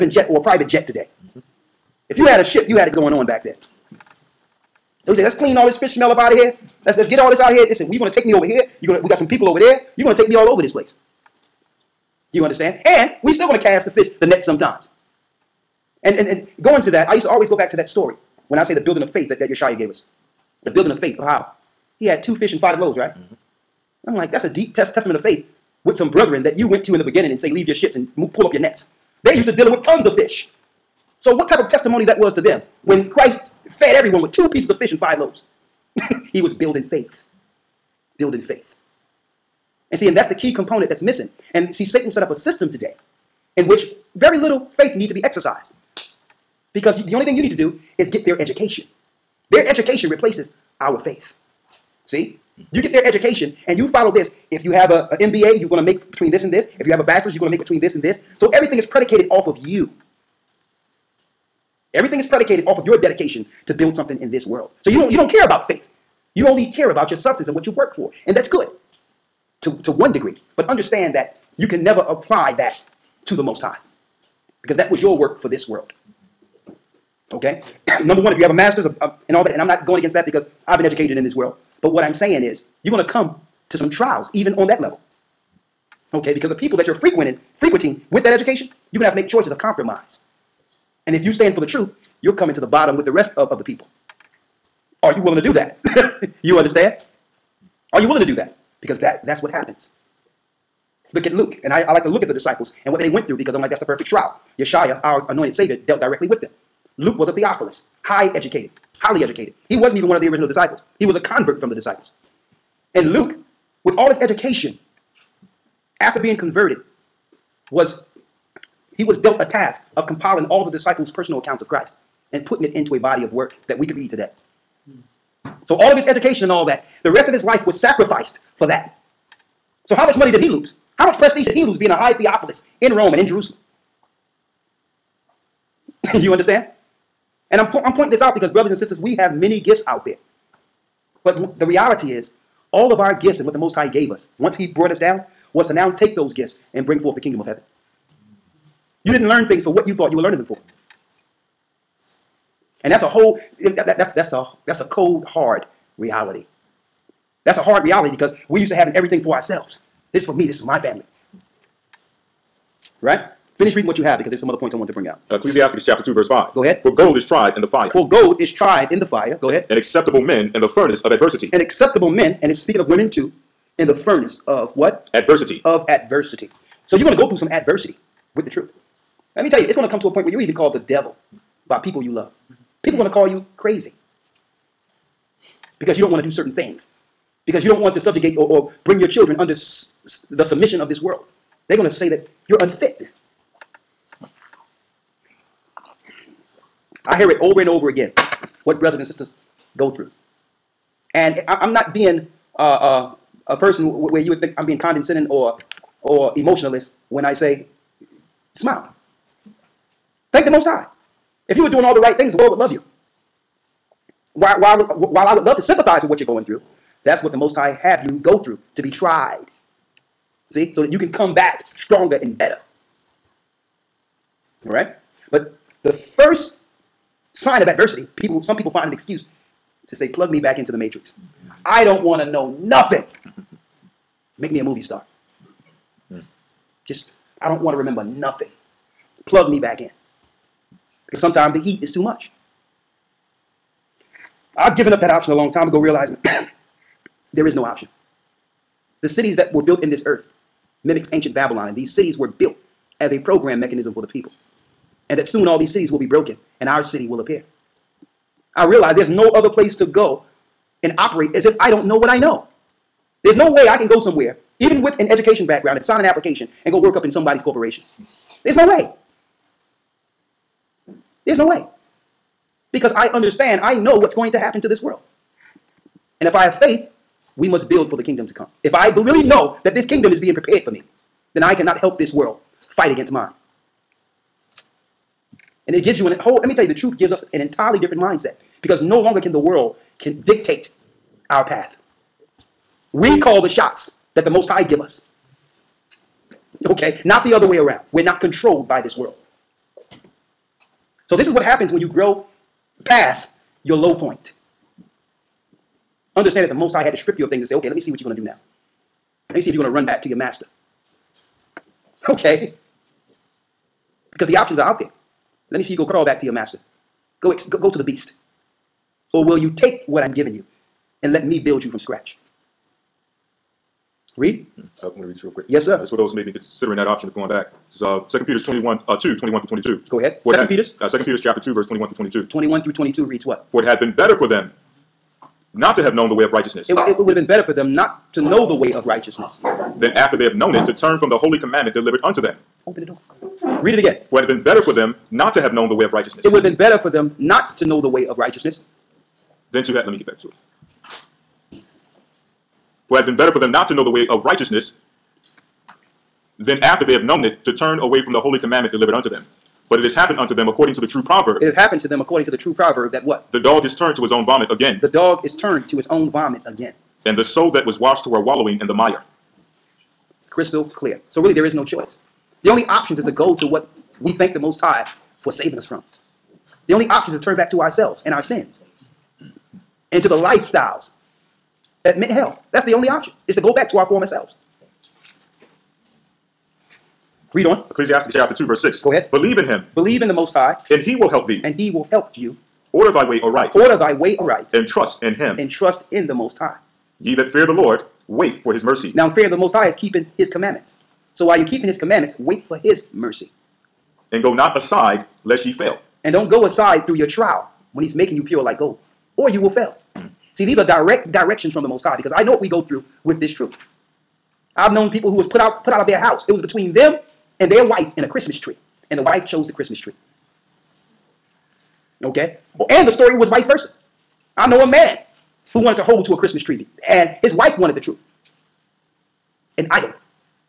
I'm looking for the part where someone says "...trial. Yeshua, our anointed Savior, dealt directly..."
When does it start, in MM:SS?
01:44.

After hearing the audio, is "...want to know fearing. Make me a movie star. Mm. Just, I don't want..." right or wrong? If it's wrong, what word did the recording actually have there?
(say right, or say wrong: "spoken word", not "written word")
wrong: "nothing", not "fearing".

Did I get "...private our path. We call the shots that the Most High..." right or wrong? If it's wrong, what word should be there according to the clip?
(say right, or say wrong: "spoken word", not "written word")
wrong: "dictate", not "private".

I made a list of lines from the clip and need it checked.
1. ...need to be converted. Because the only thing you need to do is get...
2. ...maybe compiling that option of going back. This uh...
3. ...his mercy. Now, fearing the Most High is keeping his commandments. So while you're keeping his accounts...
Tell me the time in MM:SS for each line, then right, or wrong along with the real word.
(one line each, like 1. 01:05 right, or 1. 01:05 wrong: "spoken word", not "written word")
1. 00:44 wrong: "exercised", not "converted"
2. 05:26 wrong: "considering", not "compiling"
3. 06:38 wrong: "commandments", not "accounts".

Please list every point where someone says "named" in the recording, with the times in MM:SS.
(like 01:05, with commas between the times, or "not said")
not said.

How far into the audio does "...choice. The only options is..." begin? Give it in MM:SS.
06:11.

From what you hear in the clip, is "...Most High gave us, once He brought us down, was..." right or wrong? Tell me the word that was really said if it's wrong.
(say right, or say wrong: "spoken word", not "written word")
right.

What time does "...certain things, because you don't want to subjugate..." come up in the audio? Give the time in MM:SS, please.
03:06.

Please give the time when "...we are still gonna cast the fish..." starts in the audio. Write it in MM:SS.
00:13.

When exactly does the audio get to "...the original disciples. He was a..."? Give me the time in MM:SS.
01:50.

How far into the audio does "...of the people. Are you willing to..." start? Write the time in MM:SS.
01:33.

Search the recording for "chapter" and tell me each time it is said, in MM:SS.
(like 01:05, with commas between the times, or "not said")
02:45, 05:31, 06:28.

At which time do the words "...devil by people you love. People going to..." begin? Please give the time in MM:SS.
03:00.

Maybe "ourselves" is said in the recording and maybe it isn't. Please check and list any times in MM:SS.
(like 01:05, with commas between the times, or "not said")
02:39, 06:17.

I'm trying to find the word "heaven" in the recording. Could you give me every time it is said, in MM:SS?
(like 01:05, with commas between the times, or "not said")
02:27.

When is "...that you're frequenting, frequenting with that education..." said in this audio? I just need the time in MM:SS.
01:26.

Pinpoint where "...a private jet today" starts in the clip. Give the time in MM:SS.
00:00.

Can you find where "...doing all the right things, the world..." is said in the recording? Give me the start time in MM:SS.
03:31.